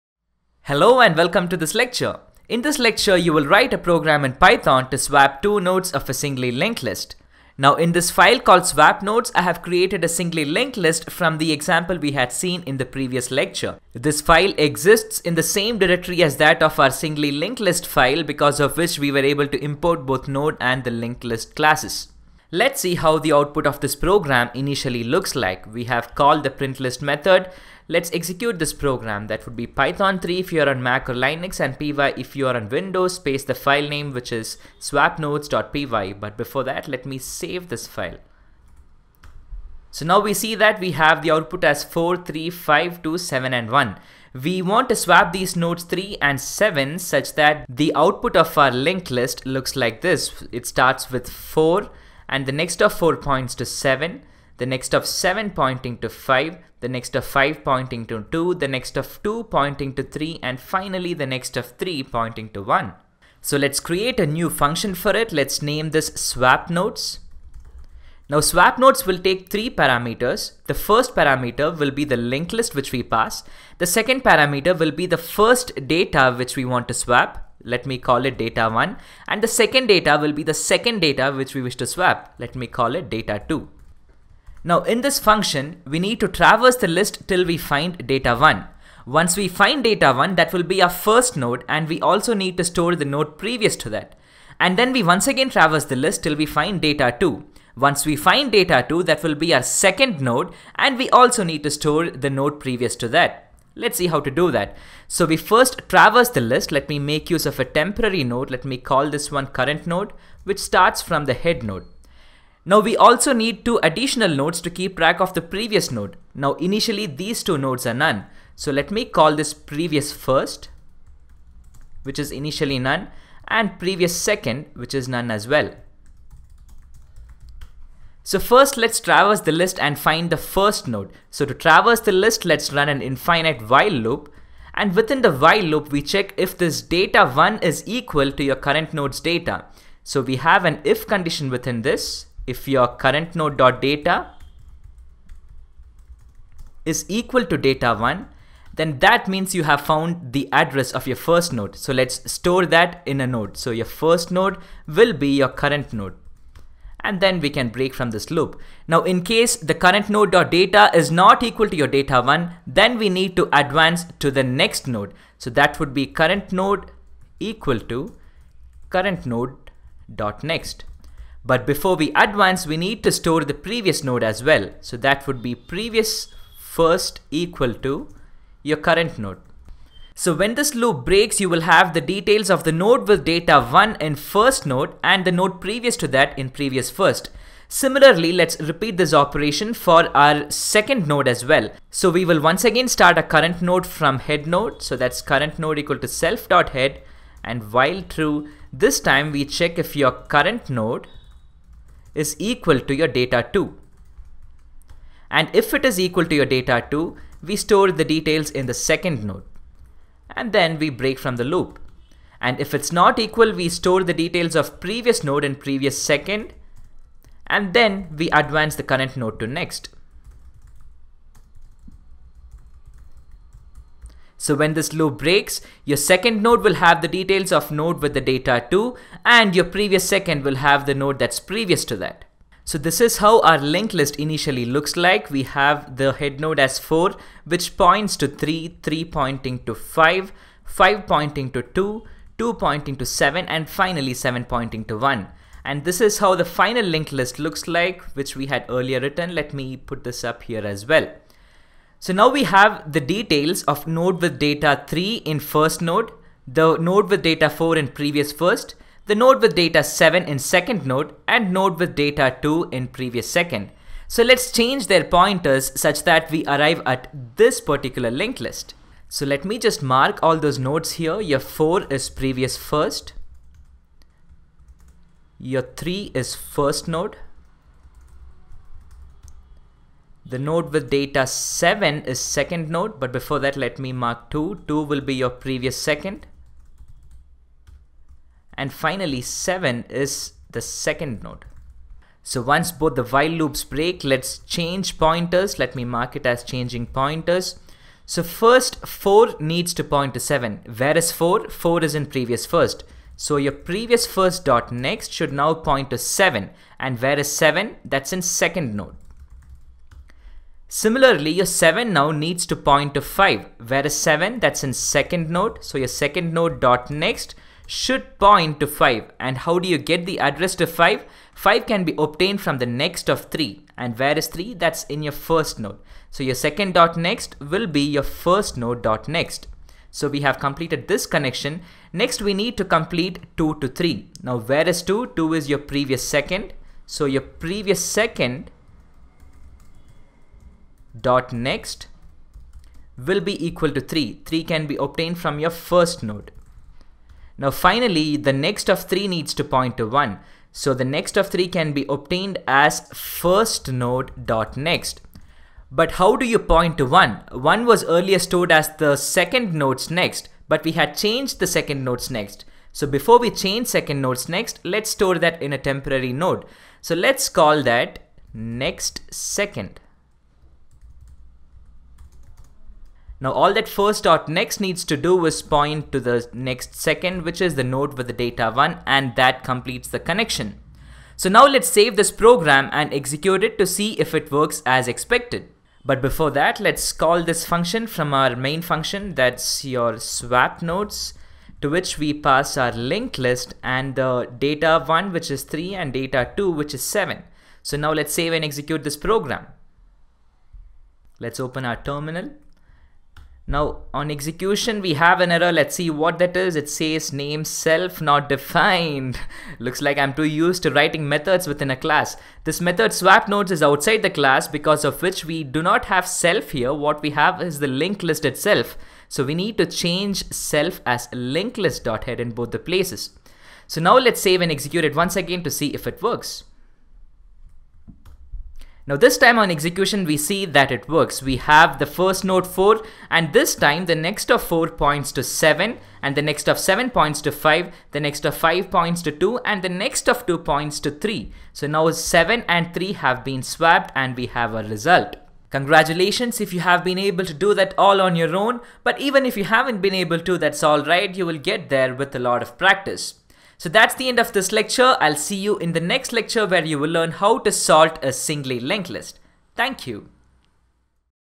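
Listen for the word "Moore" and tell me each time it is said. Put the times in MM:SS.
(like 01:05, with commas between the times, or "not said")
not said.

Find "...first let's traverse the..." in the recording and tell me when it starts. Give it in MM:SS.
02:08.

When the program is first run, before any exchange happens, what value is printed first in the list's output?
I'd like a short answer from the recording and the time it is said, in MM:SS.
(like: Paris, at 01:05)
4, at 00:41.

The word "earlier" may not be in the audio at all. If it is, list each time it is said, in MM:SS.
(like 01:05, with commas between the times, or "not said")
04:08, 05:57.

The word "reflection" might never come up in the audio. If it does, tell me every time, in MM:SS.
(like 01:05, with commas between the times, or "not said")
not said.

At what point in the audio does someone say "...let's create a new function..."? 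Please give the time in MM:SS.
01:03.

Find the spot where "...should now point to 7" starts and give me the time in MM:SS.
05:05.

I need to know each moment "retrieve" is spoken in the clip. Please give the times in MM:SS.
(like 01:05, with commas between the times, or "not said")
not said.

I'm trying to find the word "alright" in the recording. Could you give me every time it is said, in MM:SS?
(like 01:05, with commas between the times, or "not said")
07:30.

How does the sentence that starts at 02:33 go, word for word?
So your first node will be your current node and then we can break from this loop.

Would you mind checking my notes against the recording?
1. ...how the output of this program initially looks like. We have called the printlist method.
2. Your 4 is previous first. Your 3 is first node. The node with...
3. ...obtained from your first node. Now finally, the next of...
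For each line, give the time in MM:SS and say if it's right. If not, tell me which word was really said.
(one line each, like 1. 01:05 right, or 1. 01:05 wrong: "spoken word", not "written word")
1. 00:22 right
2. 04:31 right
3. 05:44 right.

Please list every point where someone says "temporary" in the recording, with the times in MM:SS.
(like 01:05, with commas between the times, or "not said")
01:47, 06:05.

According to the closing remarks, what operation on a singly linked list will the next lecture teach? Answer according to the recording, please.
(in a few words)
sort.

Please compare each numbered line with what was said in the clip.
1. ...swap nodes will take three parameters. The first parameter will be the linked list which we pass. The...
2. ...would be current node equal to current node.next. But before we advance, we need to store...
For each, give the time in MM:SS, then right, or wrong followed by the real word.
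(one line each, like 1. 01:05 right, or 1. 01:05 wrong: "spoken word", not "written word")
1. 01:08 right
2. 02:45 right.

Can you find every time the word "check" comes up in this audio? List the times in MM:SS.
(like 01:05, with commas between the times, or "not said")
02:16, 03:19.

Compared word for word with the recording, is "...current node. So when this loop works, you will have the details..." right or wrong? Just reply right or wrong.
wrong.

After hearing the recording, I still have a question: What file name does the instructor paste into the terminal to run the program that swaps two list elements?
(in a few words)
swapnodes.py.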